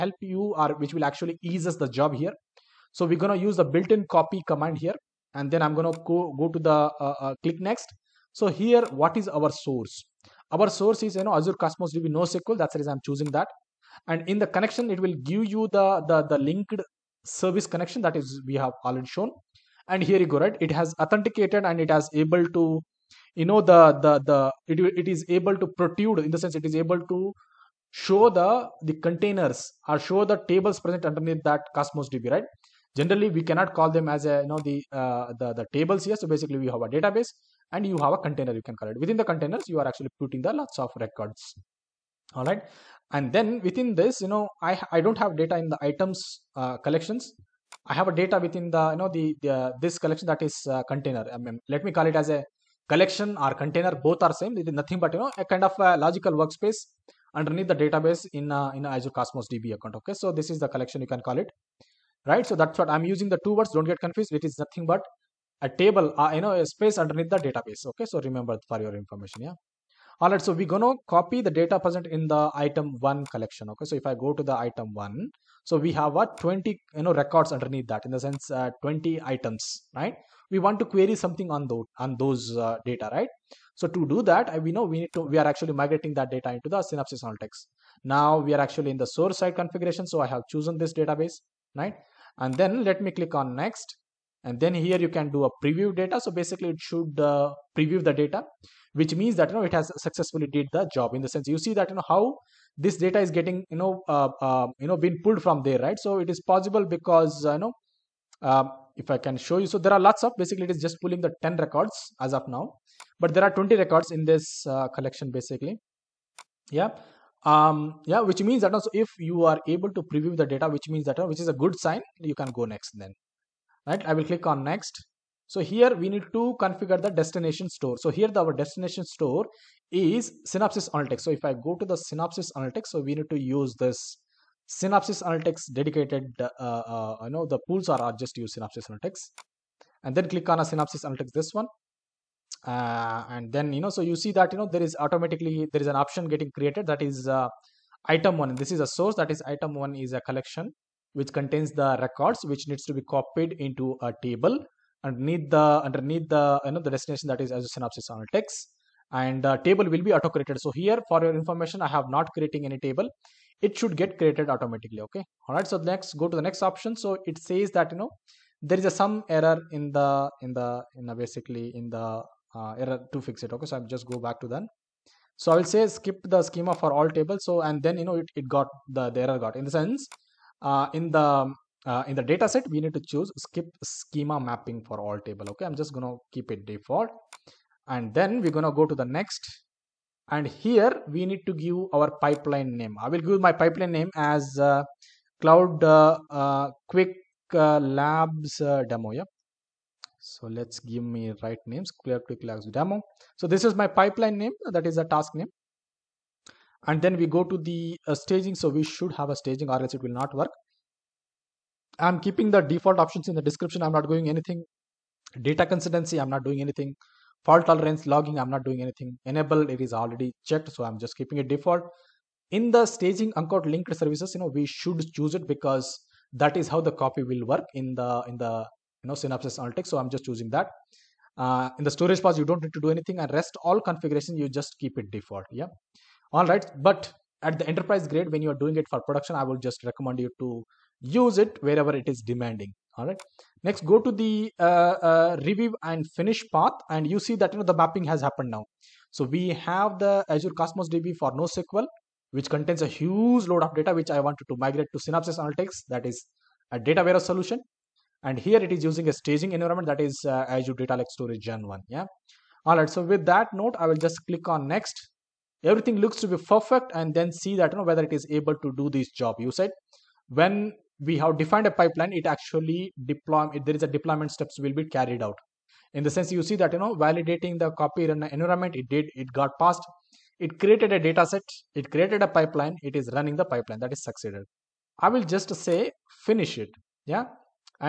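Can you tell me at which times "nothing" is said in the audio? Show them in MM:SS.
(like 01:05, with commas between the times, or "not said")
00:54, 01:04.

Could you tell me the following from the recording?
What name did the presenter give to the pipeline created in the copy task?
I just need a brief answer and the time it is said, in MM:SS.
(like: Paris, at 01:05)
Cloud Quick Labs Demo, at 03:21.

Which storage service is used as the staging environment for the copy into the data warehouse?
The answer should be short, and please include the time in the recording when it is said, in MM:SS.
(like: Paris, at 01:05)
Azure Data Lake Storage Gen 1, at 04:20.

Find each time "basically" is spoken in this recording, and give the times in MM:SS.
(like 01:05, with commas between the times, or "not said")
00:36, 01:36, 01:50, 01:55, 02:51.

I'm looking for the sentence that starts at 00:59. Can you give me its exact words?
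Okay, so this is the collection you can call it, right?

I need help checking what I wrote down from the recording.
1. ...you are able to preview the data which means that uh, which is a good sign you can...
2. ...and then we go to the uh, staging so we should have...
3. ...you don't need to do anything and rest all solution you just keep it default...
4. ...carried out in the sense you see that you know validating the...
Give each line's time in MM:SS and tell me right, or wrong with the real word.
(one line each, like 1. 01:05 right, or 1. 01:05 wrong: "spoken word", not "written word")
1. 01:59 right
2. 03:26 right
3. 03:52 wrong: "configuration", not "solution"
4. 04:34 right.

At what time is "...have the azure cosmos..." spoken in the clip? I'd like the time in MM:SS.
04:09.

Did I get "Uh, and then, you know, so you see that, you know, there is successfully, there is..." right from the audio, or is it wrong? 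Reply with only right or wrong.
wrong.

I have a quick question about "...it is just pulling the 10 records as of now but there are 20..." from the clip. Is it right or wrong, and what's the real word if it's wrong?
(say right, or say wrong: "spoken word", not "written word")
right.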